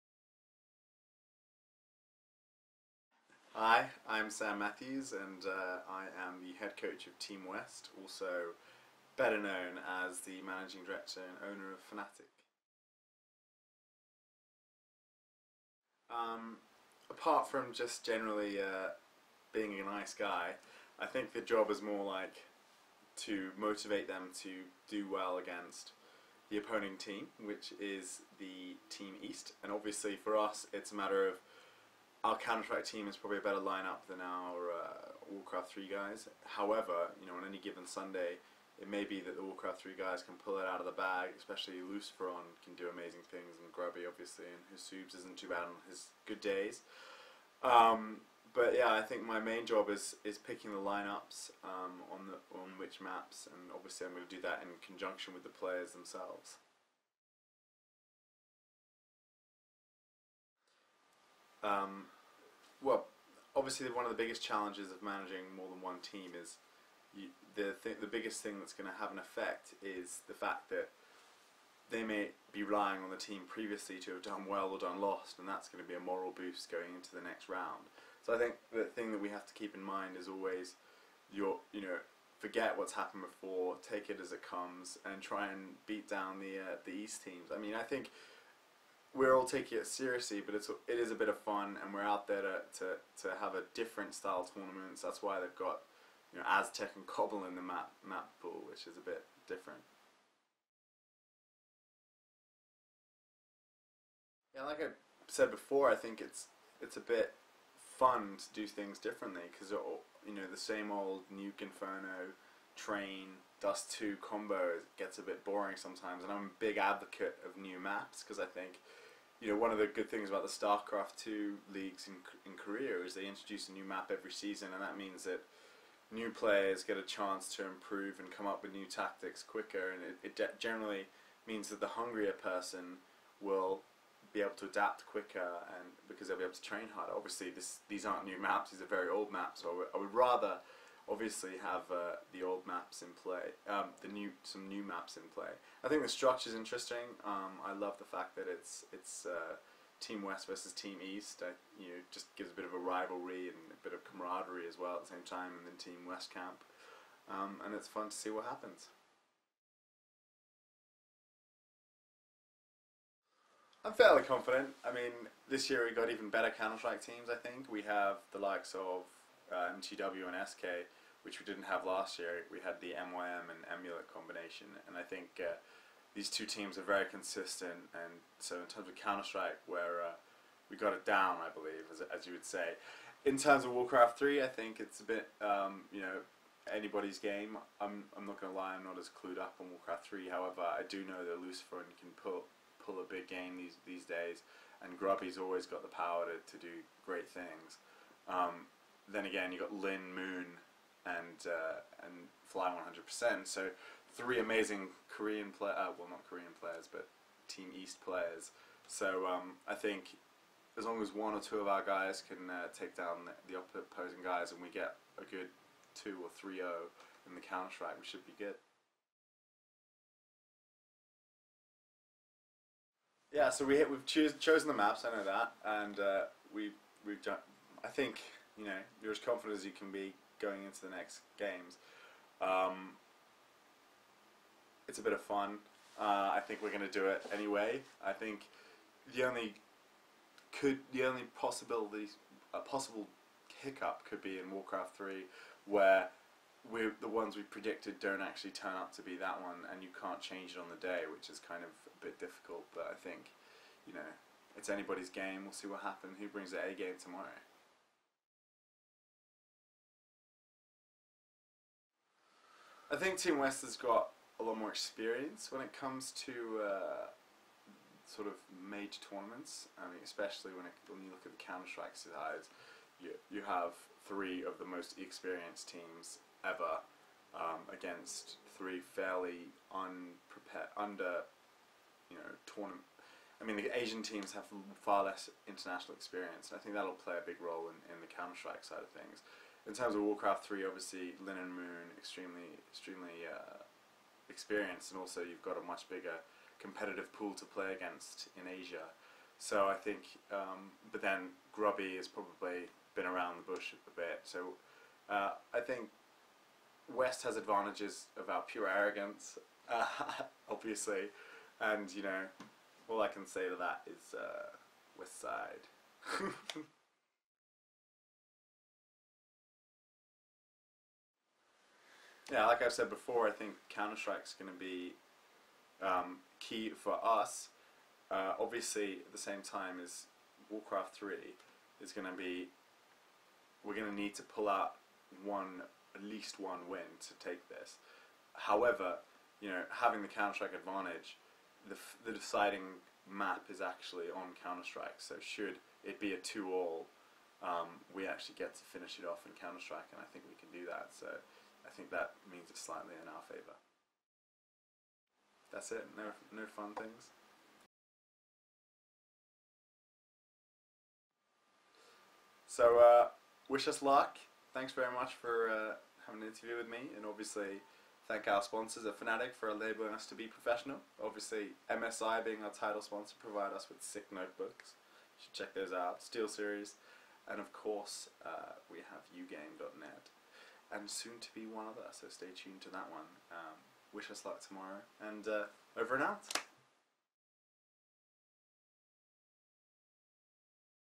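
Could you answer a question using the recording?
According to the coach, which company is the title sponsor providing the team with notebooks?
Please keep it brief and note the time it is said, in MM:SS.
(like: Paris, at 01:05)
MSI, at 06:11.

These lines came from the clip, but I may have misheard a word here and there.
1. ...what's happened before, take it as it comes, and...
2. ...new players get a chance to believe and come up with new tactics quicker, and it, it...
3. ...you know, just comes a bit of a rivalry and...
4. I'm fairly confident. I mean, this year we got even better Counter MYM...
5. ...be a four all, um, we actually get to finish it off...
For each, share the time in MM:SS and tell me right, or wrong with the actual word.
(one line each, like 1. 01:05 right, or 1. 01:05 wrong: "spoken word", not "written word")
1. 01:22 right
2. 02:06 wrong: "improve", not "believe"
3. 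02:31 wrong: "gives", not "comes"
4. 02:43 wrong: "Strike", not "MYM"
5. 05:45 wrong: "two", not "four".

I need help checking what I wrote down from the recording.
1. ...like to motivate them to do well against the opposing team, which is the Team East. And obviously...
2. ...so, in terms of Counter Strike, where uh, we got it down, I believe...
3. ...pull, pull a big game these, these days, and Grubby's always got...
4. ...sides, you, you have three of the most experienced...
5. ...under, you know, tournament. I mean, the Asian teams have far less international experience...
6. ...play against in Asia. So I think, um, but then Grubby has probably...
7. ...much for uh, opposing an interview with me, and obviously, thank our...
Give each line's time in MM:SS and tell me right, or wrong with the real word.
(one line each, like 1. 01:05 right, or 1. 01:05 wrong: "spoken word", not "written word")
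1. 00:22 right
2. 02:58 right
3. 03:12 right
4. 04:31 right
5. 04:40 right
6. 04:57 right
7. 06:04 wrong: "having", not "opposing".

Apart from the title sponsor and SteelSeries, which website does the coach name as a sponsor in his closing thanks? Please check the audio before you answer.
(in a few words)
ugame.net.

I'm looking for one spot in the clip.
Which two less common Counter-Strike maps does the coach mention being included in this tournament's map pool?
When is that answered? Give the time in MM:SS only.
01:36.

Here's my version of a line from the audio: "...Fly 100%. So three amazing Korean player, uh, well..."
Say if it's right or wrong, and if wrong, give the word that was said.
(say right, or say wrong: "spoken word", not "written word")
right.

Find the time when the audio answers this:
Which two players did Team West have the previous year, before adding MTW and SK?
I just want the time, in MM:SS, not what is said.
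02:52.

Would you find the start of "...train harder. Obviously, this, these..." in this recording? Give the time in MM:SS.
02:16.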